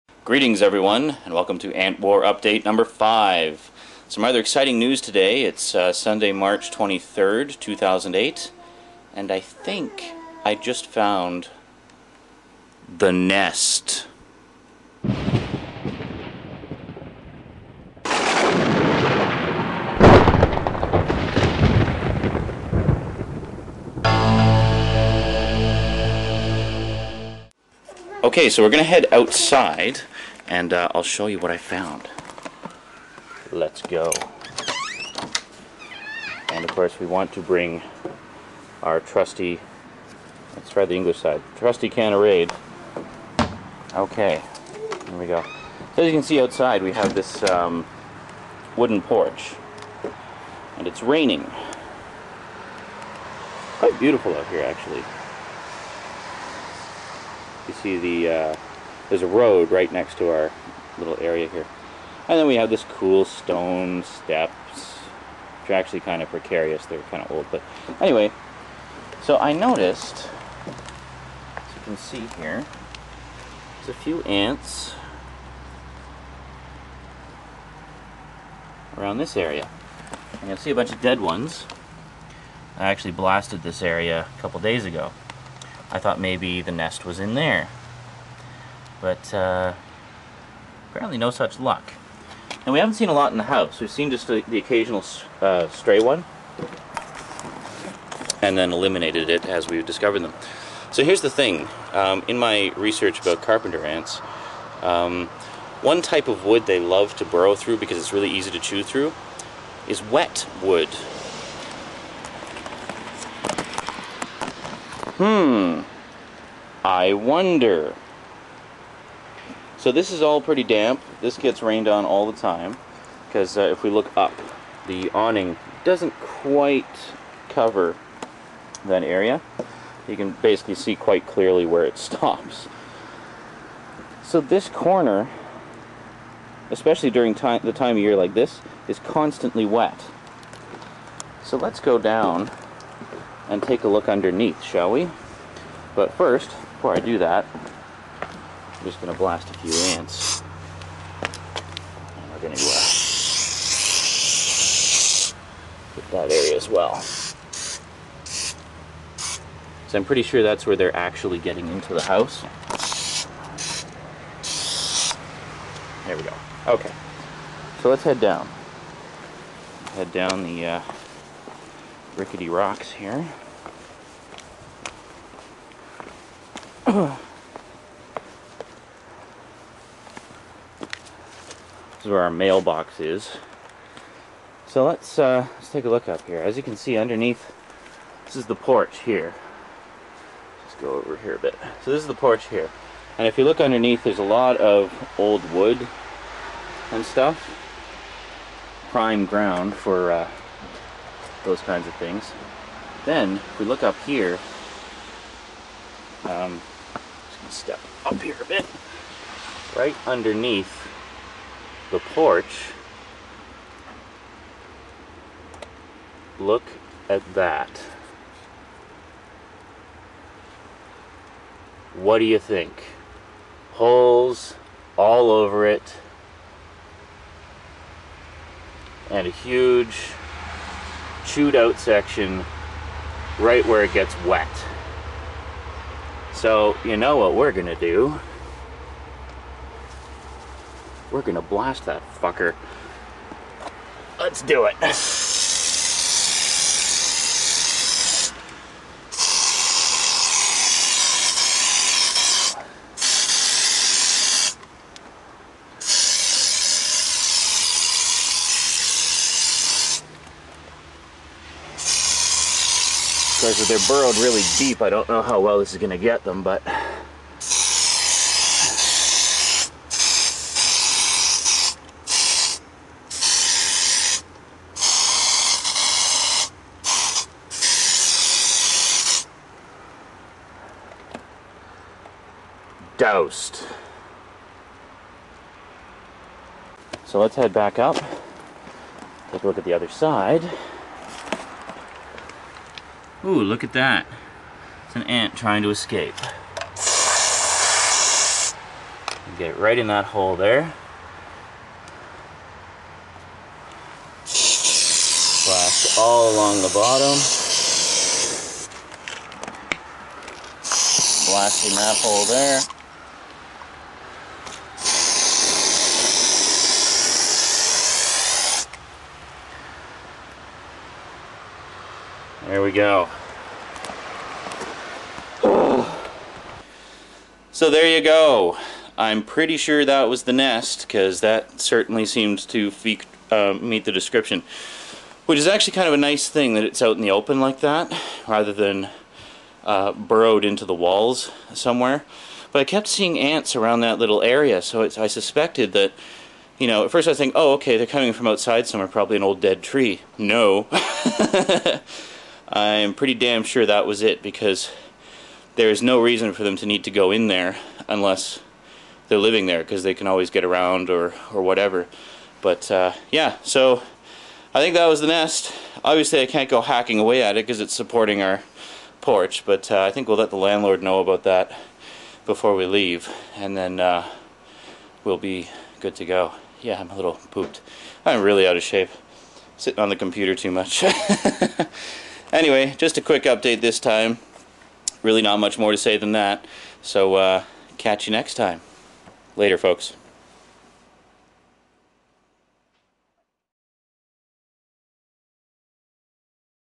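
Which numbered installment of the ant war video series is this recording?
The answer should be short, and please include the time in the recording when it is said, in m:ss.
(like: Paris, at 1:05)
5, at 0:02.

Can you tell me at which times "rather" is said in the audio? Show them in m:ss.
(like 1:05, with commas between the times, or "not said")
0:04, 5:38.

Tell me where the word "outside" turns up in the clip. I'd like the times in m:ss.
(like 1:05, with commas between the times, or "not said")
0:29, 0:46, 5:48.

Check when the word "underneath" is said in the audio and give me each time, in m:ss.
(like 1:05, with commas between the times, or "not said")
2:24, 3:06, 3:13, 3:30.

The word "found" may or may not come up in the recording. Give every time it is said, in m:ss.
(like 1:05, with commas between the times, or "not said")
0:10, 0:31.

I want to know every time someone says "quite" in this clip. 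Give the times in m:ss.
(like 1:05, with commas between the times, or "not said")
0:53, 2:06, 2:10.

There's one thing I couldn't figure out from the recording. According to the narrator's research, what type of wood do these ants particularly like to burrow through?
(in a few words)
wet wood.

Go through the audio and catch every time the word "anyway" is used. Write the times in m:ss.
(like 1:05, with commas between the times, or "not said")
1:07, 6:22.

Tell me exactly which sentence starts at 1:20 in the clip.
And you'll see a bunch of dead ones.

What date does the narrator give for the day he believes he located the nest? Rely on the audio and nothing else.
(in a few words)
March 23rd, 2008.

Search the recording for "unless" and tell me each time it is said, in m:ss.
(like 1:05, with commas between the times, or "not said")
5:57.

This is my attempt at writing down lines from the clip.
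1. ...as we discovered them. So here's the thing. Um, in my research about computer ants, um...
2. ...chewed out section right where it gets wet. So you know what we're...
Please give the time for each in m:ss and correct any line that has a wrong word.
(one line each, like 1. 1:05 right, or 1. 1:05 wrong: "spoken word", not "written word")
1. 1:39 wrong: "carpenter", not "computer"
2. 3:51 right.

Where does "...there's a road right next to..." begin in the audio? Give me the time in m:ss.
0:59.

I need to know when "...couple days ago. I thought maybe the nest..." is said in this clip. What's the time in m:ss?
1:24.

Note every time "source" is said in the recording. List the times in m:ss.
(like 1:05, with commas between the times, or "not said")
not said.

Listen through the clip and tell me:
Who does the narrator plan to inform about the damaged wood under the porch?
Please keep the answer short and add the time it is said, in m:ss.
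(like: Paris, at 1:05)
the landlord, at 6:10.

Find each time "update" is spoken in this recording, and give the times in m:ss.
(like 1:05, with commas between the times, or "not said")
0:02, 6:23.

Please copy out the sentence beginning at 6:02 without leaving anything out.
But uh, yeah, so I think that was the nest.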